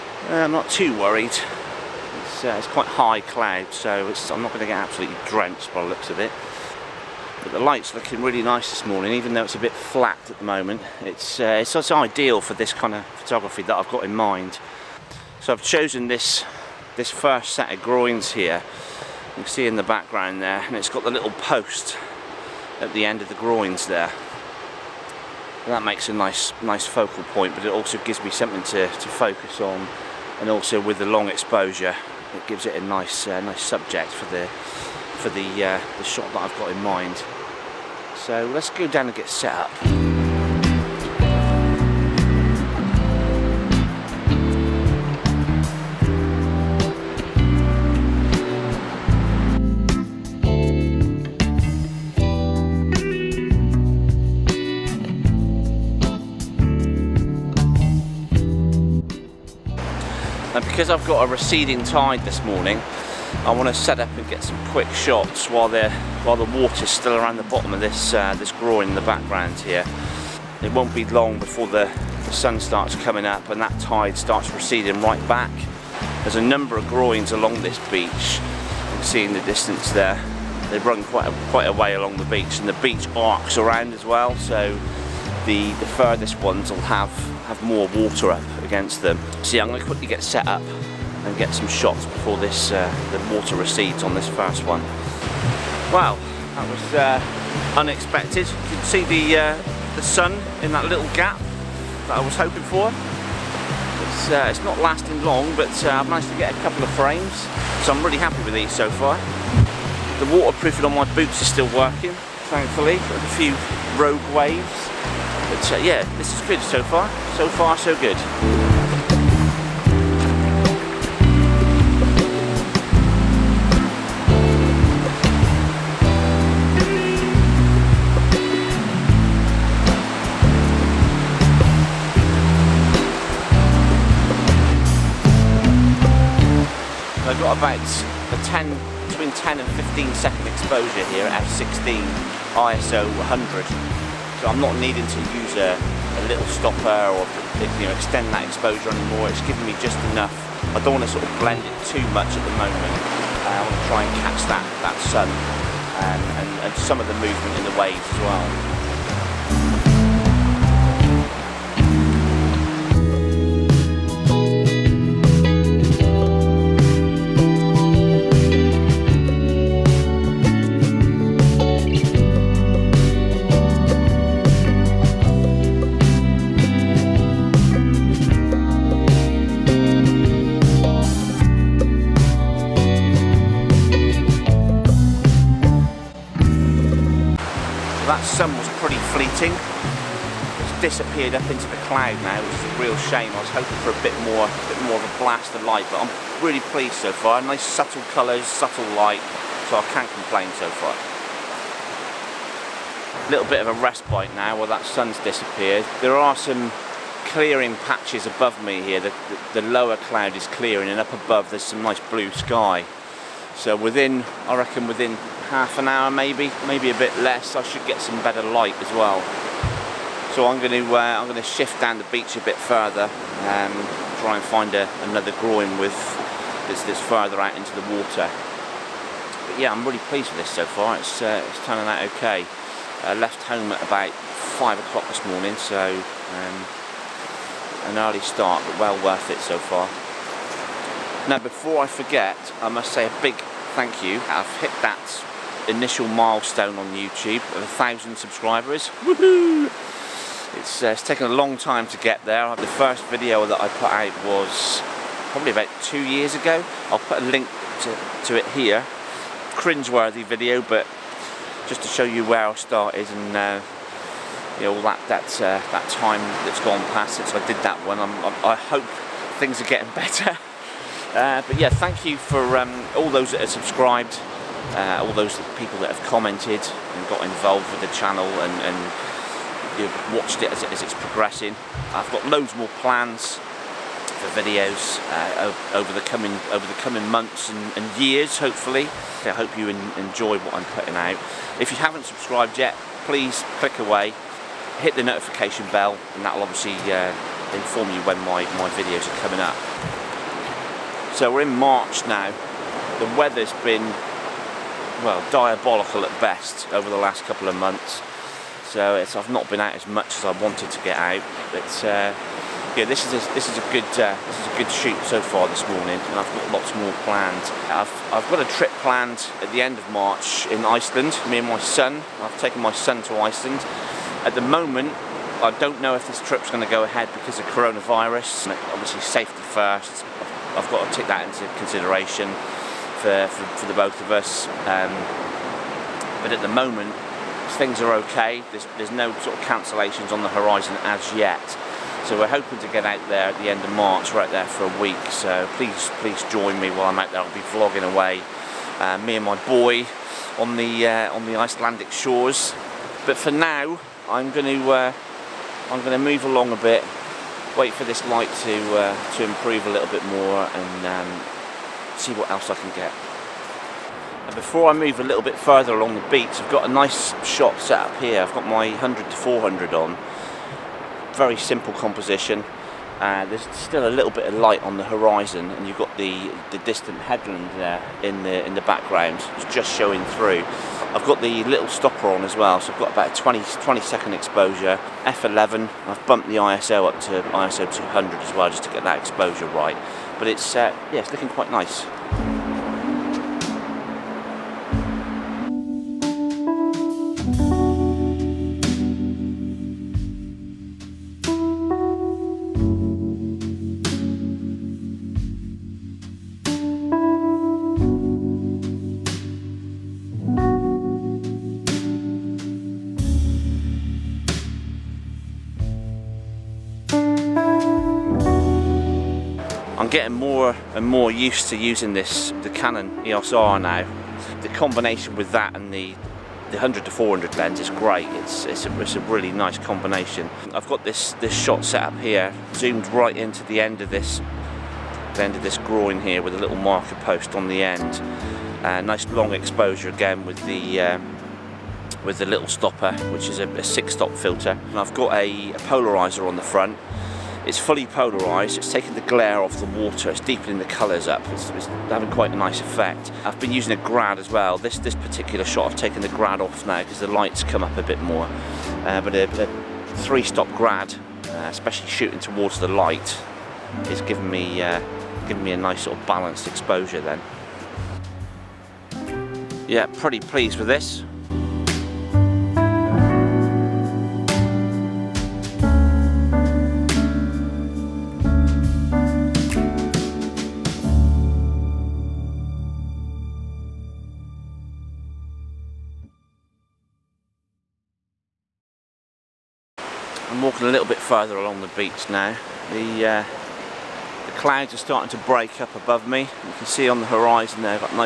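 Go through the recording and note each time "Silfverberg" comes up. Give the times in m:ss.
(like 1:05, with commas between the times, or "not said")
not said.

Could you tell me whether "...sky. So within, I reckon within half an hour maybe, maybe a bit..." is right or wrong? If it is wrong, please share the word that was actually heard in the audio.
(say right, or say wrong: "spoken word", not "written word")
right.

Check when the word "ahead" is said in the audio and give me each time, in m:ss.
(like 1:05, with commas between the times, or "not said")
5:26.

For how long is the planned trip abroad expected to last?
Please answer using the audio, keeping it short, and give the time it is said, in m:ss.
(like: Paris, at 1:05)
a week, at 5:44.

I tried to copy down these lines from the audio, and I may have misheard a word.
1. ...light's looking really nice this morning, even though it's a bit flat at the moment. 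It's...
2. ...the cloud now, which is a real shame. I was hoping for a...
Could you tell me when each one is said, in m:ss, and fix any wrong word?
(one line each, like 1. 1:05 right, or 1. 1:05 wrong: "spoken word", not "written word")
1. 0:07 right
2. 3:11 right.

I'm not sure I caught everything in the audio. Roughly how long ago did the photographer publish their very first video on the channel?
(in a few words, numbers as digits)
2 years.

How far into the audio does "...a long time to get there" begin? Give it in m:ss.
4:11.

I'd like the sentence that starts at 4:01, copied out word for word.
Now, before I forget, I must say a big thank you.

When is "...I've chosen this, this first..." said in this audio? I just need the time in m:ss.
0:15.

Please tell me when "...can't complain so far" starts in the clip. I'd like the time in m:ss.
3:19.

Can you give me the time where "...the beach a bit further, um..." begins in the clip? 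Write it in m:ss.
3:41.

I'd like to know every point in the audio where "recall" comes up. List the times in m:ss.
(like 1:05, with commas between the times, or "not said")
not said.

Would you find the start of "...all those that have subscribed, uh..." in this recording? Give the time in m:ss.
4:32.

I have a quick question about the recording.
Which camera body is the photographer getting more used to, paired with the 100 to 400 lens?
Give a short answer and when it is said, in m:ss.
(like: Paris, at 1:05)
Canon EOS R, at 7:02.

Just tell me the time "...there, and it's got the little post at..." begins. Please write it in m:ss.
0:20.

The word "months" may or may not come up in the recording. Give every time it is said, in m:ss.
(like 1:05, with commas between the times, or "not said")
4:47, 5:07.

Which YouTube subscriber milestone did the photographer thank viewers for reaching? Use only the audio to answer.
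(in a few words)
1000 subscribers.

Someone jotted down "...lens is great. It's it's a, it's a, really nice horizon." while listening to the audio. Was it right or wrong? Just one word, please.
wrong.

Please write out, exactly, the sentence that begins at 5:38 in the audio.
There's, there's no sort of cancellations on the horizon as yet.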